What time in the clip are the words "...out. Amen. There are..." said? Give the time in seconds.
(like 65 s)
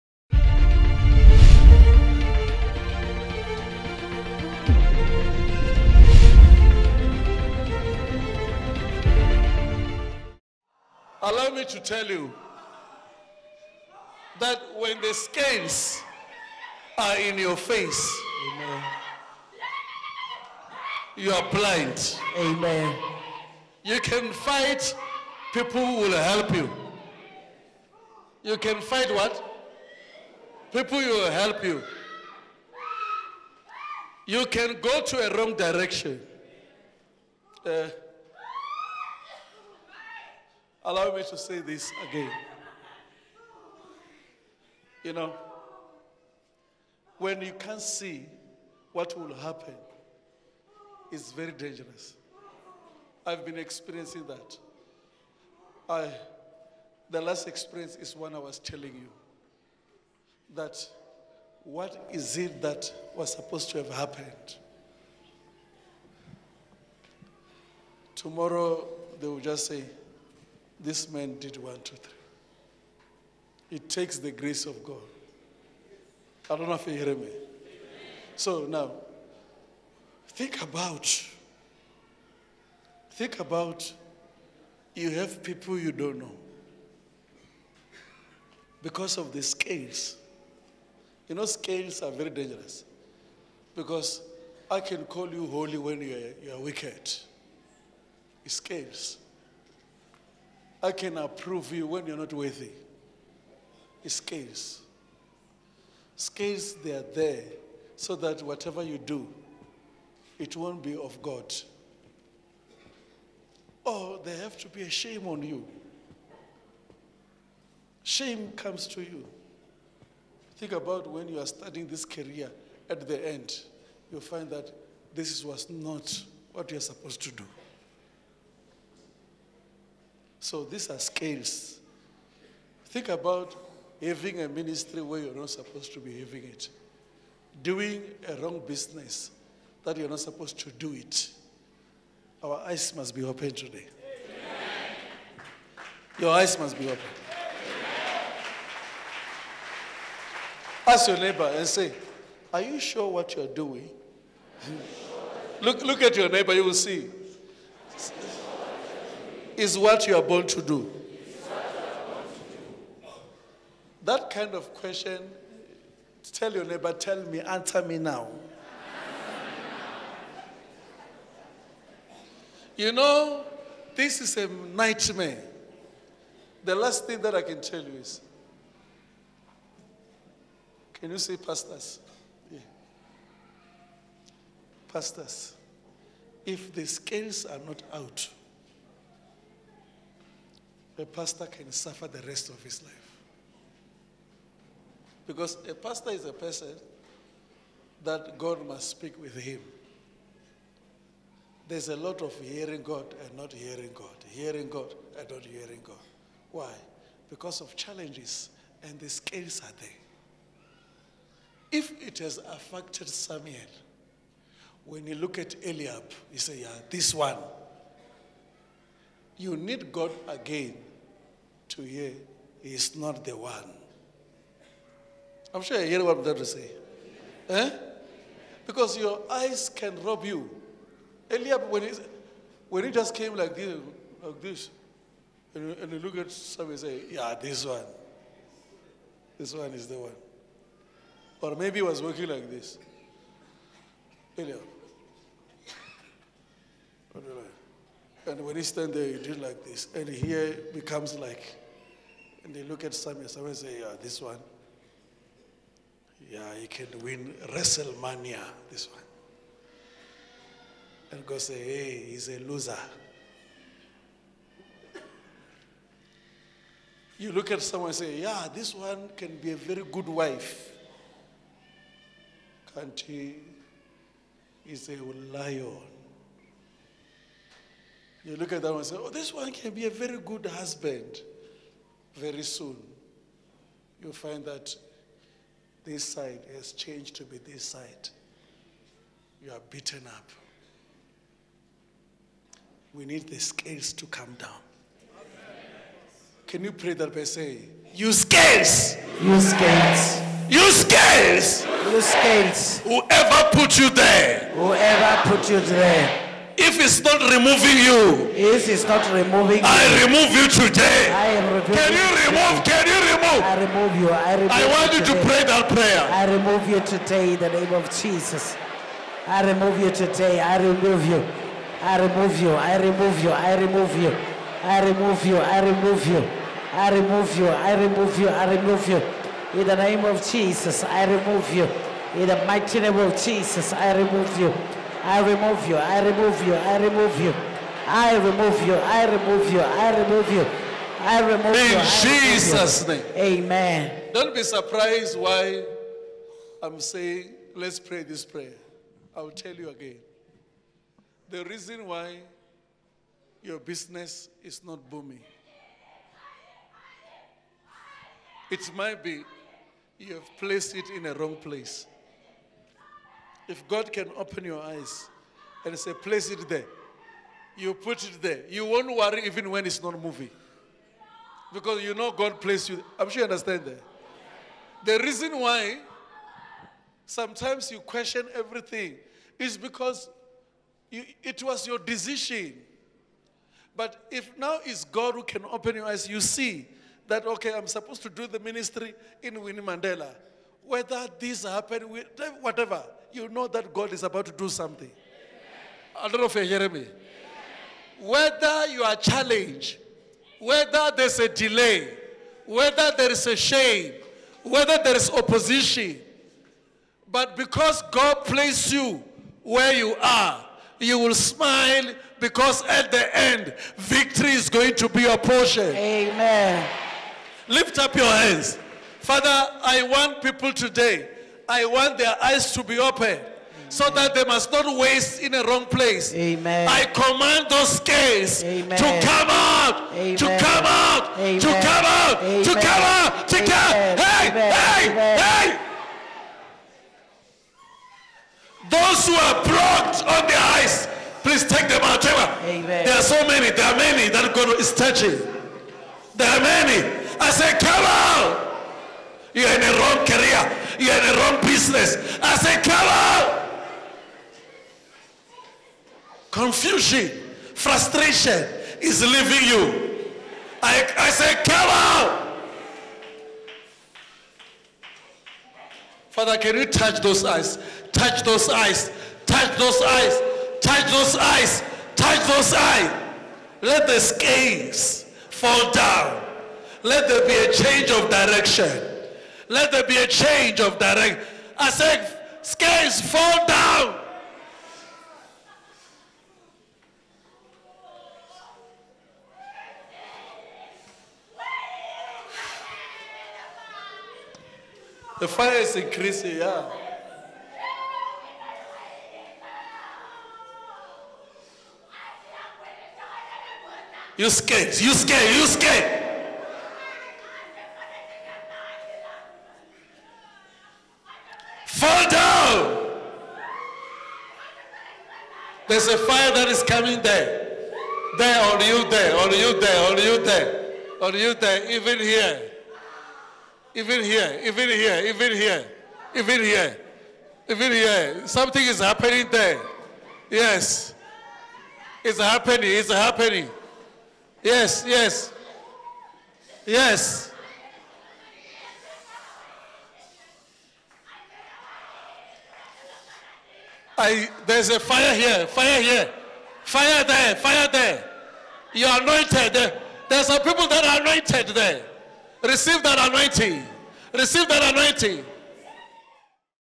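441 s.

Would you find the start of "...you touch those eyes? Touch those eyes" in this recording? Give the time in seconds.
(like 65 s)
466 s.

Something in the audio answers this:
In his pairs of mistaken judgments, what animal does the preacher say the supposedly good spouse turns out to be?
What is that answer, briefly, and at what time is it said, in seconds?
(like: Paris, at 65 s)
a lion, at 274 s.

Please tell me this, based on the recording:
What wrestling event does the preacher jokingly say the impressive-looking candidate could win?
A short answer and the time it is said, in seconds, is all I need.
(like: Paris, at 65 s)
WrestleMania, at 257 s.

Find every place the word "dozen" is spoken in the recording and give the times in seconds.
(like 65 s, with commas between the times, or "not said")
not said.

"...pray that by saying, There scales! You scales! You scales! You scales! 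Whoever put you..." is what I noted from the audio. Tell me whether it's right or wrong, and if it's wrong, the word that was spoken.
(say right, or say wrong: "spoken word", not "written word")
wrong: "You", not "There".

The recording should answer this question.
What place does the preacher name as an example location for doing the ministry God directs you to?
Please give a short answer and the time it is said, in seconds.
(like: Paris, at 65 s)
Winnie Mandela, at 389 s.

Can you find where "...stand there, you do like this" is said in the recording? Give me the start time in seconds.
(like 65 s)
248 s.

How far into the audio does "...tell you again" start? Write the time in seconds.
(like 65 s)
349 s.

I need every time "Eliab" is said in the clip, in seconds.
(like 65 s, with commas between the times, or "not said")
215 s, 231 s, 244 s.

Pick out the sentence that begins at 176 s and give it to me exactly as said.
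The last thing that I can tell you is can you see pastors?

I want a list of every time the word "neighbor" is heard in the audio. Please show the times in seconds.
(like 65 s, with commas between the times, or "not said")
151 s, 156 s, 166 s.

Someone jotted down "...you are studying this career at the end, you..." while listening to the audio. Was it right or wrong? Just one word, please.
right.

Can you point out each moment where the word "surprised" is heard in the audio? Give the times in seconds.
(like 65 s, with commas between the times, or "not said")
344 s.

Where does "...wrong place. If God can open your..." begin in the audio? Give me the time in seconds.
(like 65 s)
361 s.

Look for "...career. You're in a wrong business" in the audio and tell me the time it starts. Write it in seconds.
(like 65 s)
450 s.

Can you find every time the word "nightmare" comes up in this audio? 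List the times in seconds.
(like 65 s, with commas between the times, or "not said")
174 s.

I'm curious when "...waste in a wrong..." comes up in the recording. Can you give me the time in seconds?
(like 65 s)
424 s.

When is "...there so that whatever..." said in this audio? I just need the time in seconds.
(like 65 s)
107 s.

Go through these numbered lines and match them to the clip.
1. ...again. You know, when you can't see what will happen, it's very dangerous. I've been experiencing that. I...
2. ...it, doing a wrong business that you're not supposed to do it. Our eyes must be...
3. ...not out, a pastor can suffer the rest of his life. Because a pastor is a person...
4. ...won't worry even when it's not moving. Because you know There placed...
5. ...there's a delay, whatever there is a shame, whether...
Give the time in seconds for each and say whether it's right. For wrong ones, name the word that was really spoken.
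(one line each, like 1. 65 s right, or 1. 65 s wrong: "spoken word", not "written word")
1. 42 s right
2. 136 s right
3. 187 s right
4. 368 s wrong: "God", not "There"
5. 400 s wrong: "whether", not "whatever".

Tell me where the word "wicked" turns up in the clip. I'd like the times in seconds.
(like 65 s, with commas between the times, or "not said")
96 s.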